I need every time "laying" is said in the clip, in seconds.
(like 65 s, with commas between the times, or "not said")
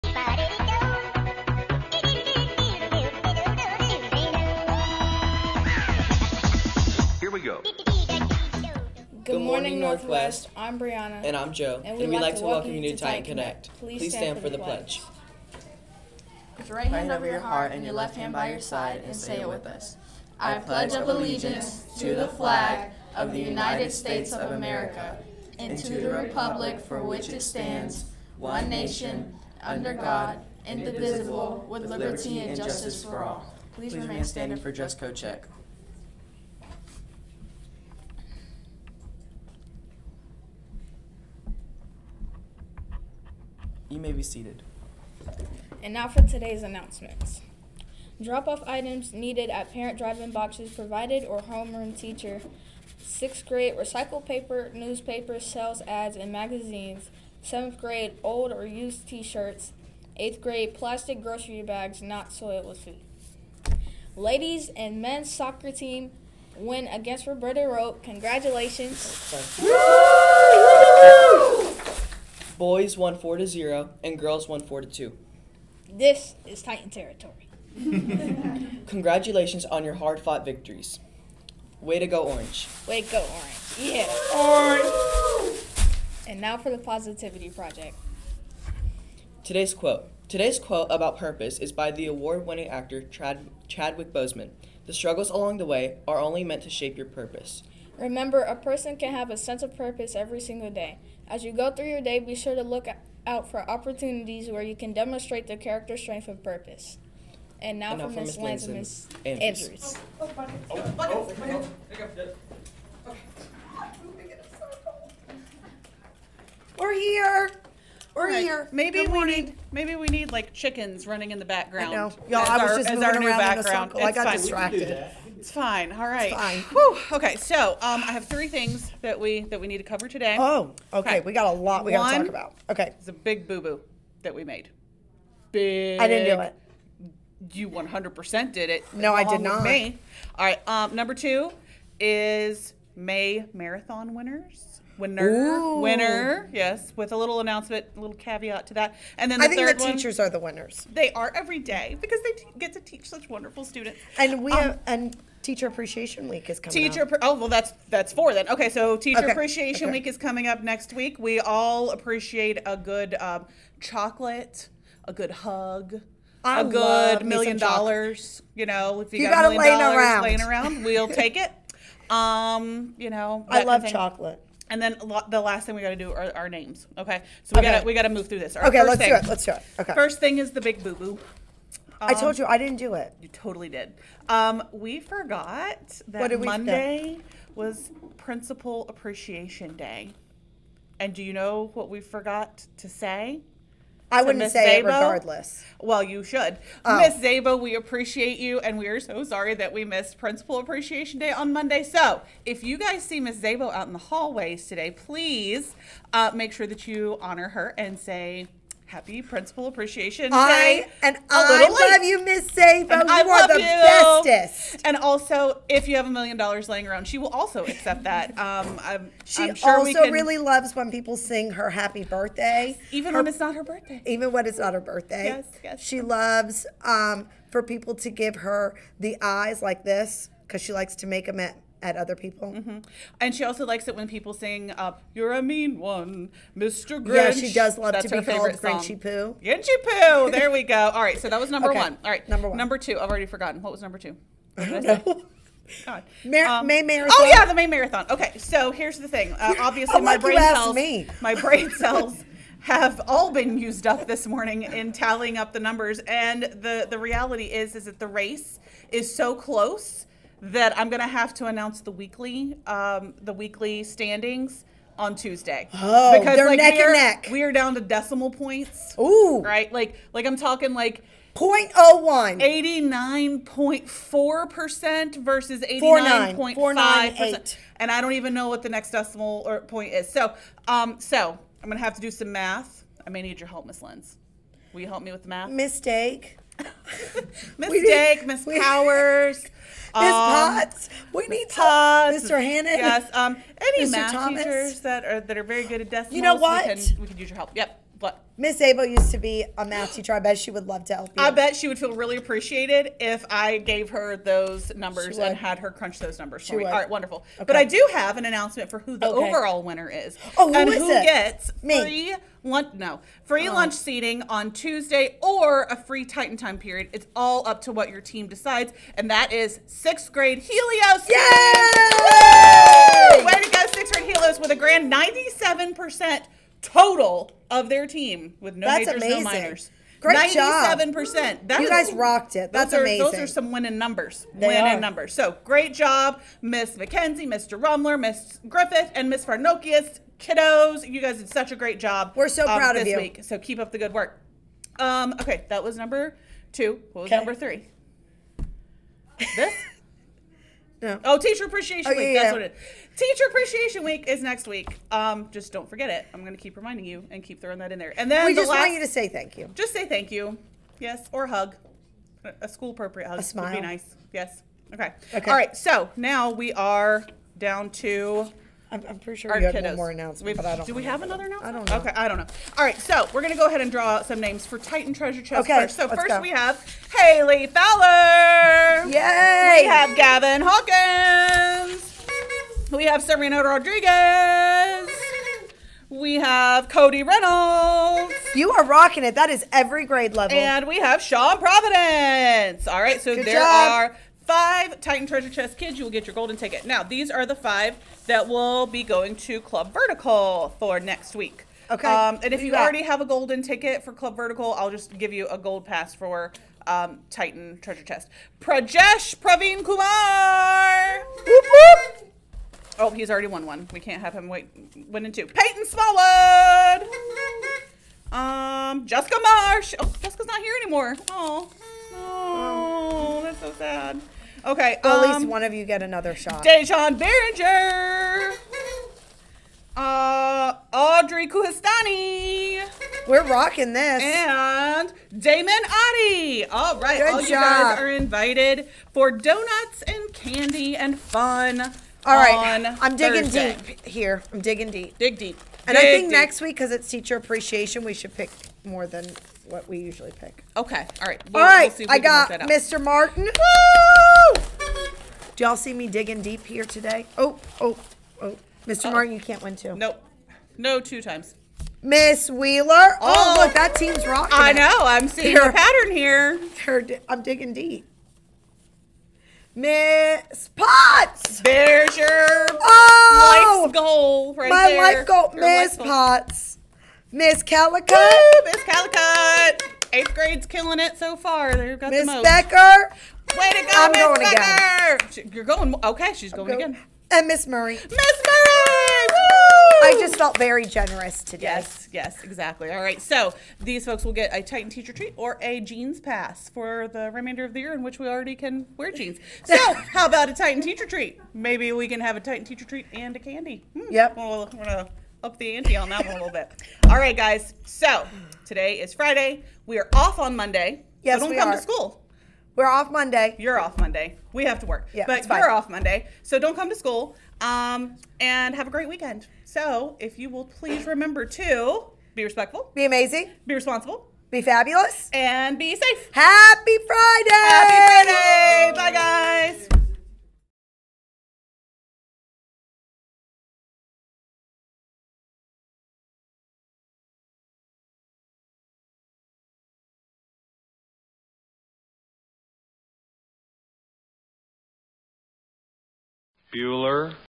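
170 s, 216 s.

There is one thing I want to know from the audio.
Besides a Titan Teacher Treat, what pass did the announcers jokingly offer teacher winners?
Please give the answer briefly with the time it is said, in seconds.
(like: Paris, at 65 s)
Jeans Pass, at 495 s.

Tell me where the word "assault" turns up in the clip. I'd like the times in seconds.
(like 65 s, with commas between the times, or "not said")
not said.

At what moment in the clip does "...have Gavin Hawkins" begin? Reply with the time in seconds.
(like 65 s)
379 s.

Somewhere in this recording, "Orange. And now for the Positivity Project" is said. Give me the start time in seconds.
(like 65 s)
84 s.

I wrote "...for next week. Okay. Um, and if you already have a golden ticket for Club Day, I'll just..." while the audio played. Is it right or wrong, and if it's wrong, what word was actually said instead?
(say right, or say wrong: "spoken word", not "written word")
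wrong: "Vertical", not "Day".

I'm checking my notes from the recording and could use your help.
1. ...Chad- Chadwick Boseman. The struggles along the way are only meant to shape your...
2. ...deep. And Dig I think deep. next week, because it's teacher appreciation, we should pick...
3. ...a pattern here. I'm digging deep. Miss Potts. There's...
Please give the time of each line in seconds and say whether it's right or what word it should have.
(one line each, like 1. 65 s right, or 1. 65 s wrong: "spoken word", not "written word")
1. 93 s right
2. 445 s right
3. 465 s right.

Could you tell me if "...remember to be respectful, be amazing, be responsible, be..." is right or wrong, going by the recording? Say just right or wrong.
right.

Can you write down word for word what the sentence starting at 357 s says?
And then we the just last, want you to say thank you.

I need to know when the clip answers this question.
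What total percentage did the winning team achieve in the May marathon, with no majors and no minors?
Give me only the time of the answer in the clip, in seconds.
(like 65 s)
324 s.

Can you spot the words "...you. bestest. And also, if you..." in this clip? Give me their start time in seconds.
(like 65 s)
213 s.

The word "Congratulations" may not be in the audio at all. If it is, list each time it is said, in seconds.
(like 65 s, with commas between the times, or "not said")
68 s, 78 s.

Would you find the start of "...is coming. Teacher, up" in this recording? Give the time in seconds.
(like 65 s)
156 s.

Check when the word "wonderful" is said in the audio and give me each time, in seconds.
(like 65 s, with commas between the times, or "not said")
153 s, 306 s.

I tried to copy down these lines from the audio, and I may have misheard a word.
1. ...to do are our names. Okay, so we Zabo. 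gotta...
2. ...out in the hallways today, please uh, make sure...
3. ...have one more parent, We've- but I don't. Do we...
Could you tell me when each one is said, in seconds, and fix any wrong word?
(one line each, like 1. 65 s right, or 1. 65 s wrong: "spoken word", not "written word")
1. 175 s wrong: "Okay", not "Zabo"
2. 203 s right
3. 369 s wrong: "announcement", not "parent".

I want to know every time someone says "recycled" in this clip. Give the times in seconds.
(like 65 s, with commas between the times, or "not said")
53 s.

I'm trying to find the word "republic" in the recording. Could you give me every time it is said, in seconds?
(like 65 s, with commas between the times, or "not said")
26 s.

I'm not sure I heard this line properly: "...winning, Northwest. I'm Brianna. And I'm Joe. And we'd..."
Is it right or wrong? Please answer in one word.
wrong.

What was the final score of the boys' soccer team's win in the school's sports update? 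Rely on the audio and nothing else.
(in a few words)
4 to 0.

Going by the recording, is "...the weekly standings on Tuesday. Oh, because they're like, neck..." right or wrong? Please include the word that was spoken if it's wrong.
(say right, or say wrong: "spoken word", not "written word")
right.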